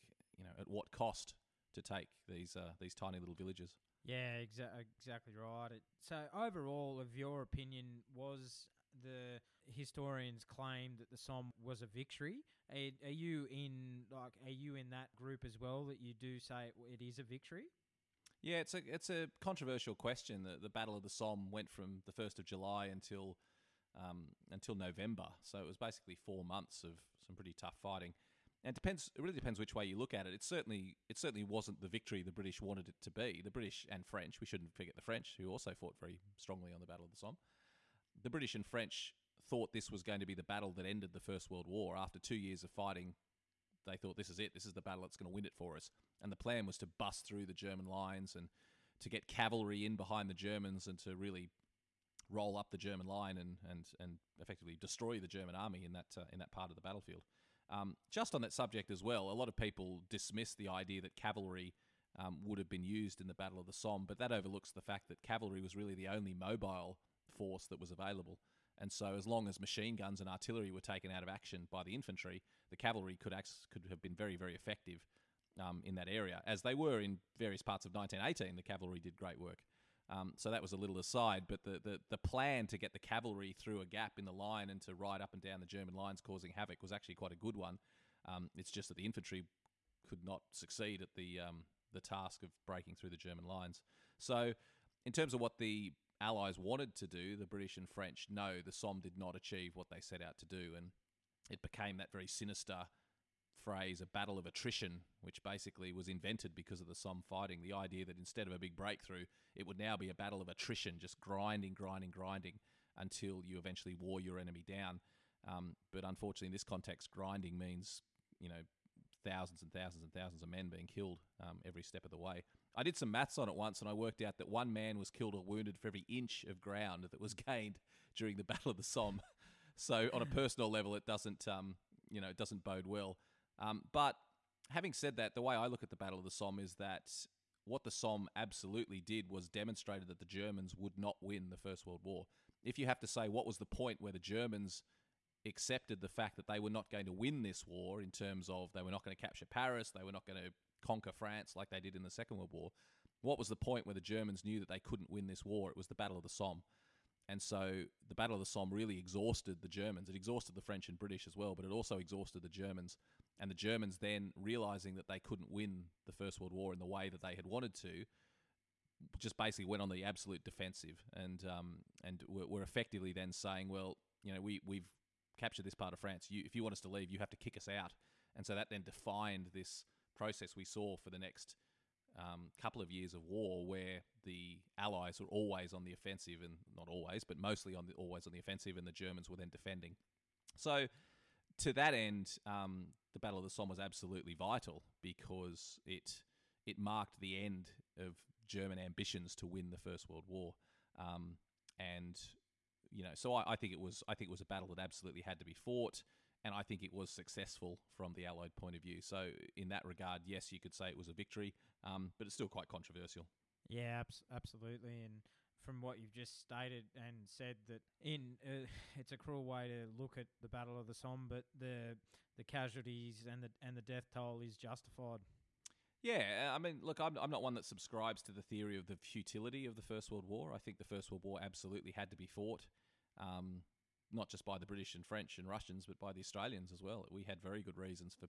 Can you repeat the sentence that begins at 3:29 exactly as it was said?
So in that regard, yes, you could say it was a victory, um, but it's still quite controversial.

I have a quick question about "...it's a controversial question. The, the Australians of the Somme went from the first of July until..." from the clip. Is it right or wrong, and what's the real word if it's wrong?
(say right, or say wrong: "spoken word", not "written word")
wrong: "Battle", not "Australians".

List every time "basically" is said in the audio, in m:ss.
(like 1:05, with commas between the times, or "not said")
0:25, 1:45, 2:49.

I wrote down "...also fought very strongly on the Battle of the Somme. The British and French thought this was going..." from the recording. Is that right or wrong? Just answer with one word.
right.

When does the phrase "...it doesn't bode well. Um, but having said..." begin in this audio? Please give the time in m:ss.
2:12.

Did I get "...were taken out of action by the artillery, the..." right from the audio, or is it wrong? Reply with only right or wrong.
wrong.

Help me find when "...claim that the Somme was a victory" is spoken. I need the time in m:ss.
0:10.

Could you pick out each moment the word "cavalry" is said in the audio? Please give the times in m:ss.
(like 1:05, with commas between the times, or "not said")
0:49, 1:01, 1:05, 1:12, 1:18, 1:22.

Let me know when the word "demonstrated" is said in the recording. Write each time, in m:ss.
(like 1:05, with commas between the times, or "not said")
2:19.